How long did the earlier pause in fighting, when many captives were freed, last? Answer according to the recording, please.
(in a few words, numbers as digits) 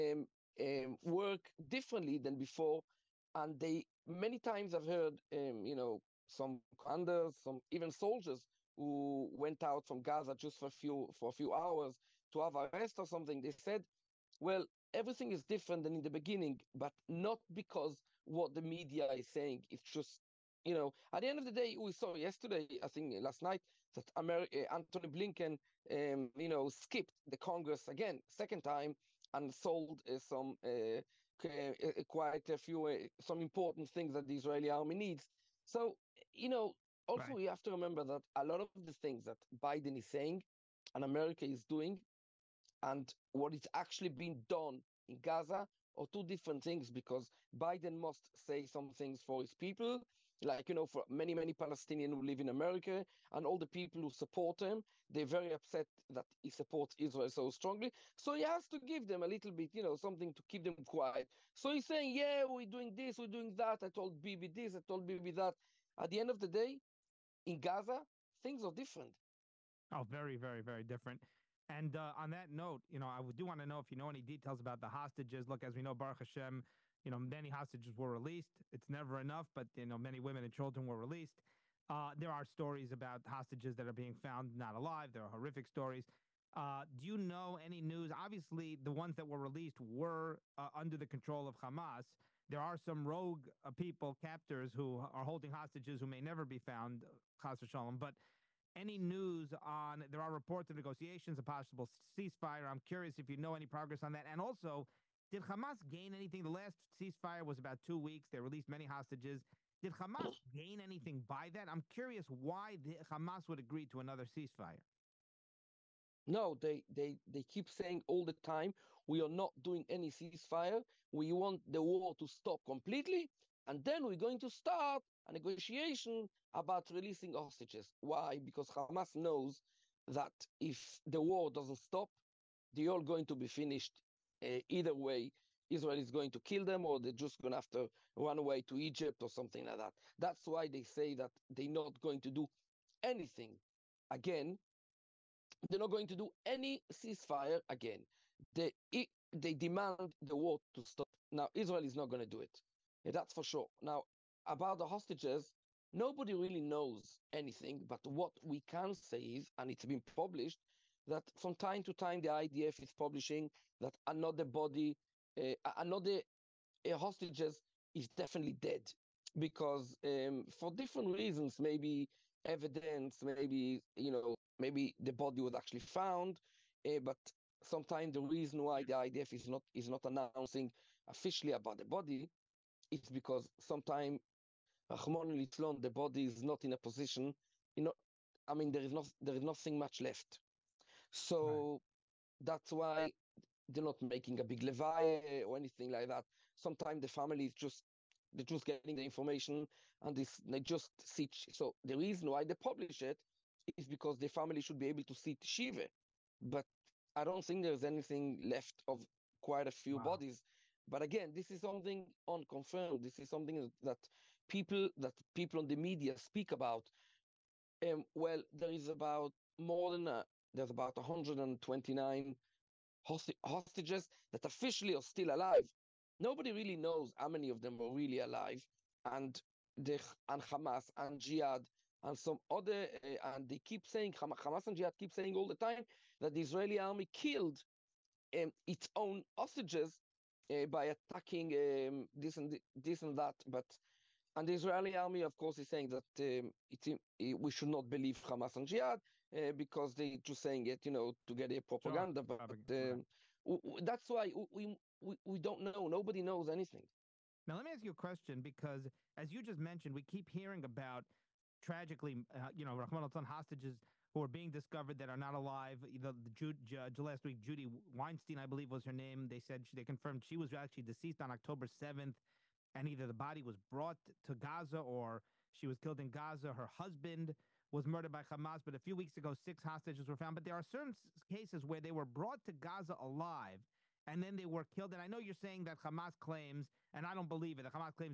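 about two weeks.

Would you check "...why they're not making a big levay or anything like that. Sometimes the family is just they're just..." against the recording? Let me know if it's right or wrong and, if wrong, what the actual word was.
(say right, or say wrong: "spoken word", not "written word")
right.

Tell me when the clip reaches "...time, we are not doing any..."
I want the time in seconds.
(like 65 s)
118 s.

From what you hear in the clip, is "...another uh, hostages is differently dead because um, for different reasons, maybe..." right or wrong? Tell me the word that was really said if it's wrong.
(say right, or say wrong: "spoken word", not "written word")
wrong: "definitely", not "differently".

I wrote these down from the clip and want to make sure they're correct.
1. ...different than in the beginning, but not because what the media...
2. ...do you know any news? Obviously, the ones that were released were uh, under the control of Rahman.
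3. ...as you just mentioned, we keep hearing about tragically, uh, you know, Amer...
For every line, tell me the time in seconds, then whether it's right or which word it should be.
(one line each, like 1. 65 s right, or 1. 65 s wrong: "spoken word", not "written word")
1. 15 s right
2. 86 s wrong: "Hamas", not "Rahman"
3. 259 s wrong: "Rahman", not "Amer".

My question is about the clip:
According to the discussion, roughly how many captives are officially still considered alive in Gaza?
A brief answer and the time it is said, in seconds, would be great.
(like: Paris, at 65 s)
129, at 220 s.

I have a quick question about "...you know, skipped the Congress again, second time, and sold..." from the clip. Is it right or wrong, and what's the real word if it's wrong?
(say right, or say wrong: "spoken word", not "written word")
right.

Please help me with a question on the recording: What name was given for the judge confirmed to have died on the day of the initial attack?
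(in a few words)
Judy Weinstein.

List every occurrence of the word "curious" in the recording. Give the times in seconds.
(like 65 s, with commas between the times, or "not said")
102 s, 111 s.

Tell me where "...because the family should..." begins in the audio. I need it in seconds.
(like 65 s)
203 s.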